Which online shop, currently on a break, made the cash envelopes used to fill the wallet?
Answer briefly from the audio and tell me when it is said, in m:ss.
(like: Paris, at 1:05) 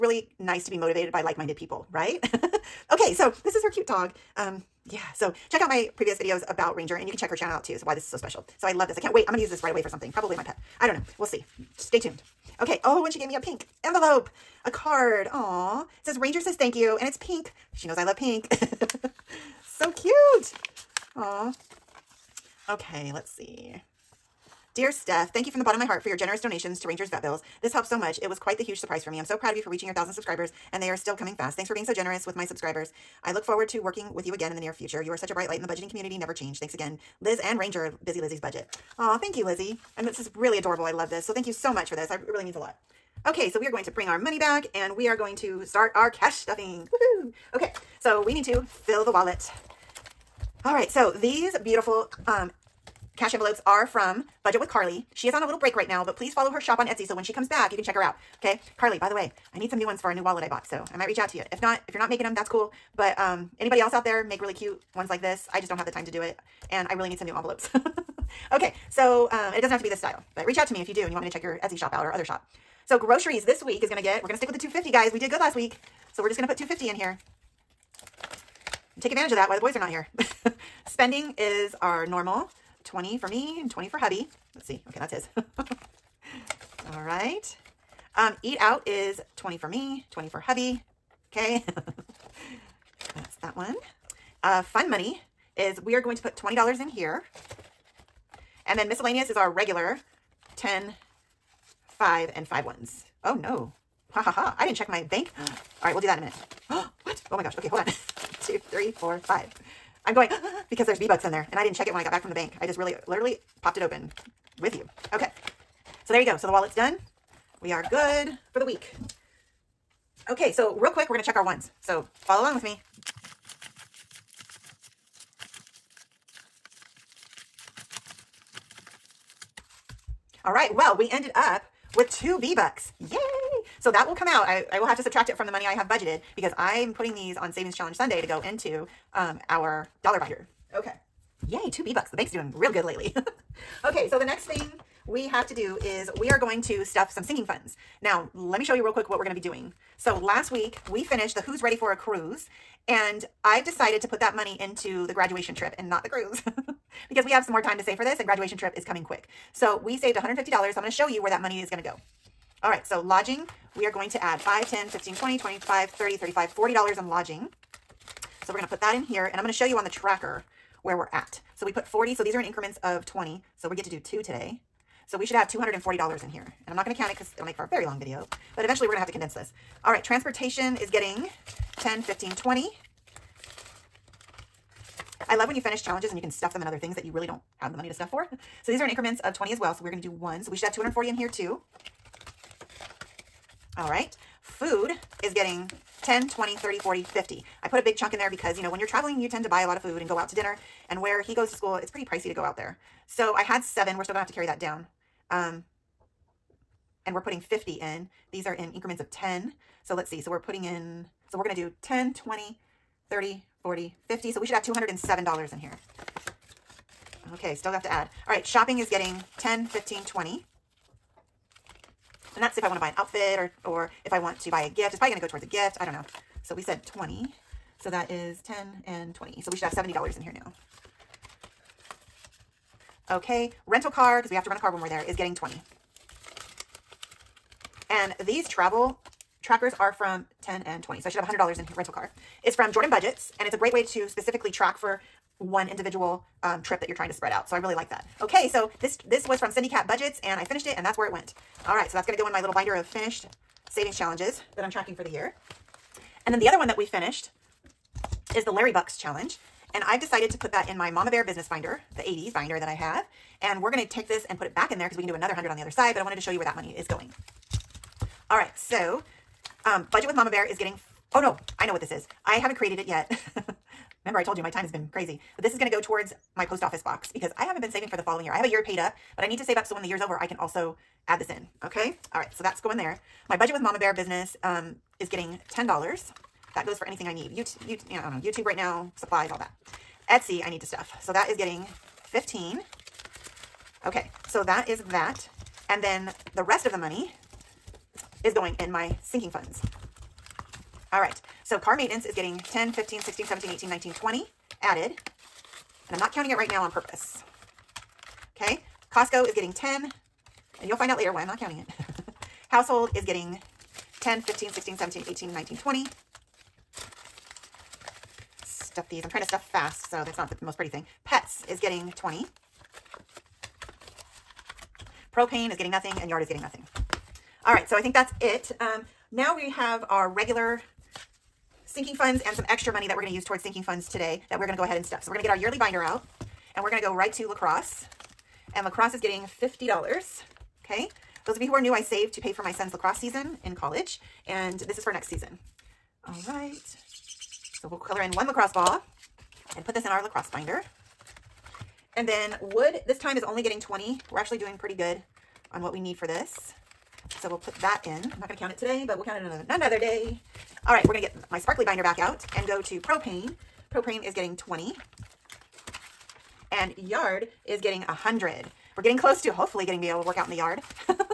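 Budget with Carly, at 0:54.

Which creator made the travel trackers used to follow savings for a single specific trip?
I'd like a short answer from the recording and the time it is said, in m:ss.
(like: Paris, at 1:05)
Jordan Budgets, at 4:02.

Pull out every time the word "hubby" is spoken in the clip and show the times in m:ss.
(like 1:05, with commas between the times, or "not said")
1:23, 1:30.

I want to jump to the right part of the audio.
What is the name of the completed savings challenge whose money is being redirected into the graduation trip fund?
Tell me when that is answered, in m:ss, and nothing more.
2:31.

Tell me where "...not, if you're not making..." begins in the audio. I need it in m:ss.
1:01.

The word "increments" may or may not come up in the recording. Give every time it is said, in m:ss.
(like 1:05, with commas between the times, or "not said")
2:52, 3:08, 3:28.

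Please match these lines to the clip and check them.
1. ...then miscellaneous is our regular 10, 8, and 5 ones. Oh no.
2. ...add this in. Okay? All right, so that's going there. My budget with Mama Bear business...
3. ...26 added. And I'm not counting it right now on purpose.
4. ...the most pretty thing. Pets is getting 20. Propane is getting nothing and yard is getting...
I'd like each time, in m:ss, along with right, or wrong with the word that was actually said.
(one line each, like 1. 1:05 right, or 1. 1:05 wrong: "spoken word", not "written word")
1. 1:38 wrong: "5", not "8"
2. 4:41 right
3. 5:03 wrong: "20", not "26"
4. 5:20 right.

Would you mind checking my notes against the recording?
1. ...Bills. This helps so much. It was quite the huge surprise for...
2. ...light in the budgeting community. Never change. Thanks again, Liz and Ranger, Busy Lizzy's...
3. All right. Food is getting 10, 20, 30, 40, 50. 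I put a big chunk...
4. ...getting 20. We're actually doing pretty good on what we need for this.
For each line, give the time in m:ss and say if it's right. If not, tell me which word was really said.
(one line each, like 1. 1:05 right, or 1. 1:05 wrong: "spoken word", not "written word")
1. 0:27 right
2. 0:35 right
3. 3:13 right
4. 5:53 right.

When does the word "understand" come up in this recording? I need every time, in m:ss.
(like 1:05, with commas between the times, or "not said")
not said.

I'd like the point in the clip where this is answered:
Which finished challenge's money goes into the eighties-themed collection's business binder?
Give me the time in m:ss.
4:18.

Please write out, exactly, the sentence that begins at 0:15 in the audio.
Aww says Ranger says thank you, and it's pink.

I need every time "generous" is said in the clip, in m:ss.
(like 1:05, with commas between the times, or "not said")
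0:26, 0:31.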